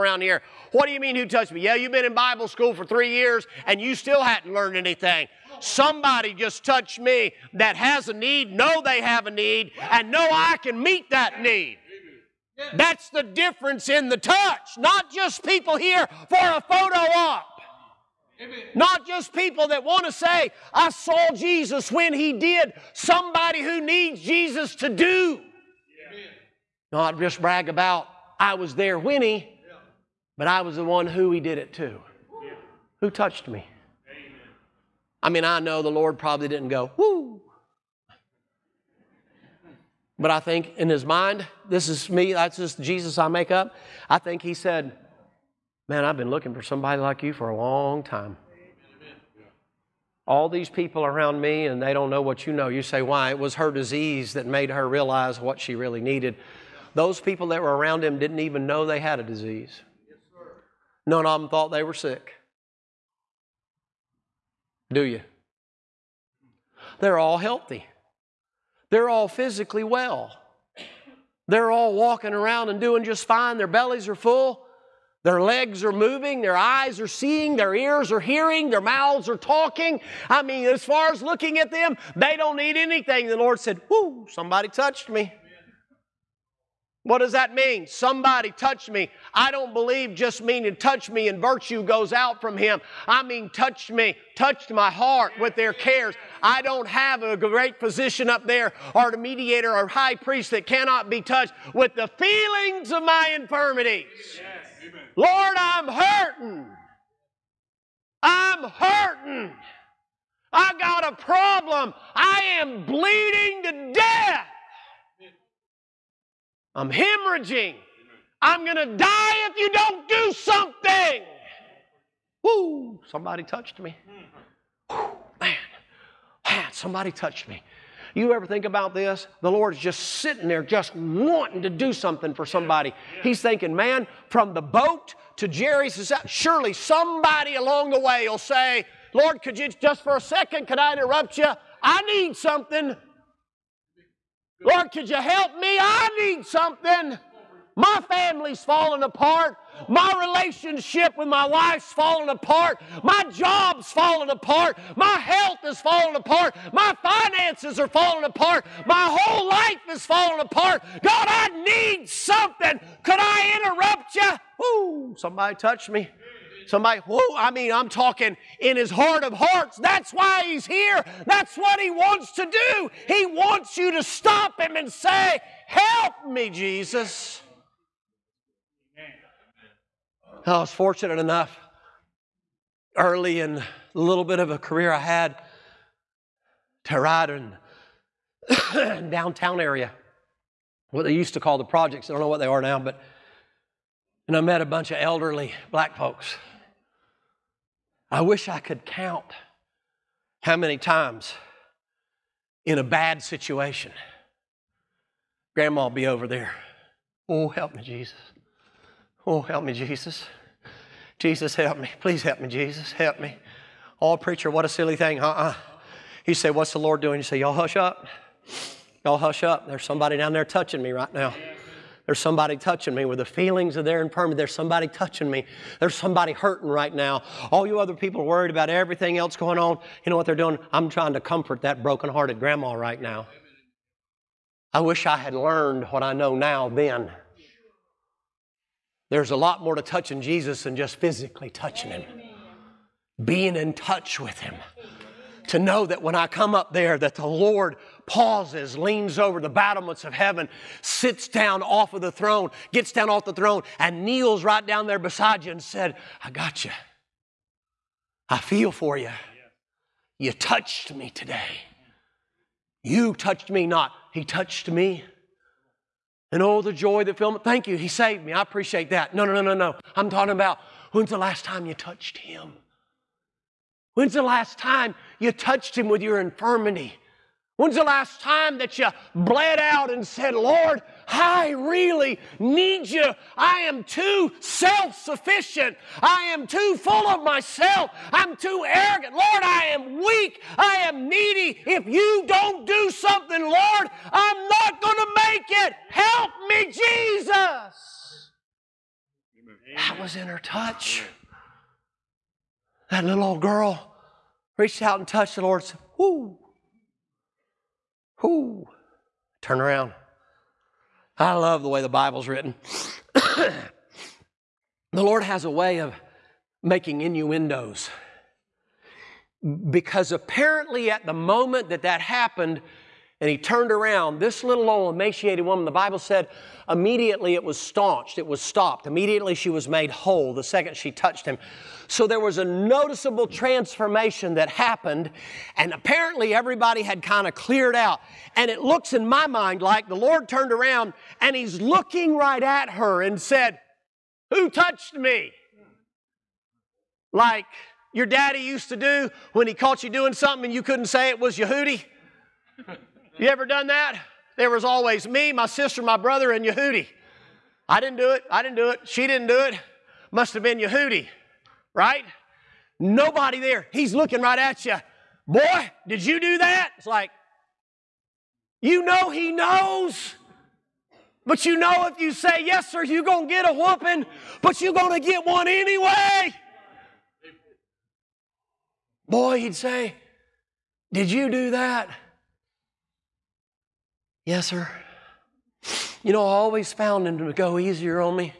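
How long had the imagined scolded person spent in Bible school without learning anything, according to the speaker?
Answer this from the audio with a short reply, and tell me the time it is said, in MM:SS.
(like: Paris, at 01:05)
3 years, at 00:02.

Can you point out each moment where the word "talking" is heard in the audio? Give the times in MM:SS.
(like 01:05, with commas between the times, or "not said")
01:19, 02:47, 04:30.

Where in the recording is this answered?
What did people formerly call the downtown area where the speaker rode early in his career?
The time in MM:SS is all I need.
03:11.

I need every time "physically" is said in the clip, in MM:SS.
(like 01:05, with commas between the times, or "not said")
01:09, 04:00.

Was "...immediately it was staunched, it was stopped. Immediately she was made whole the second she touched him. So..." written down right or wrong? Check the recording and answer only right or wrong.
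right.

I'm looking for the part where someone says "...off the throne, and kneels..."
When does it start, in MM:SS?
04:13.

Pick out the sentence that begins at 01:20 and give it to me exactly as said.
I mean, as far as looking at them, they don't need anything.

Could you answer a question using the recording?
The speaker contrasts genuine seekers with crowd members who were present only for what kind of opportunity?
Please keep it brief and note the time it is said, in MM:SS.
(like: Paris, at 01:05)
photo op, at 00:16.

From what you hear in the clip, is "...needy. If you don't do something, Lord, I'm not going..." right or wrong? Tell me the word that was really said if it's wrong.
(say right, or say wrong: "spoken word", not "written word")
right.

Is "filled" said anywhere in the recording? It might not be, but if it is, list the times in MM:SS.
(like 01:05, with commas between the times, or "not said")
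04:27.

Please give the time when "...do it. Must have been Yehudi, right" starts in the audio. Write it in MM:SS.
05:59.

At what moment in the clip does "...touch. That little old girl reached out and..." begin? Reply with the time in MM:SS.
05:00.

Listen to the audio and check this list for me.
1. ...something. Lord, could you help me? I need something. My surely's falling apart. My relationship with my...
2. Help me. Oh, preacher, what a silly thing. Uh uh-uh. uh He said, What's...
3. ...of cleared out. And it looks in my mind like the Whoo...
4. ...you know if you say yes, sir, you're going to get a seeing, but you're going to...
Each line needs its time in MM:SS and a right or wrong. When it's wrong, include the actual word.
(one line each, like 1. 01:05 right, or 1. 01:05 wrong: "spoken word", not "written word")
1. 02:22 wrong: "family", not "surely"
2. 03:32 right
3. 05:37 wrong: "Lord", not "Whoo"
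4. 06:11 wrong: "whooping", not "seeing".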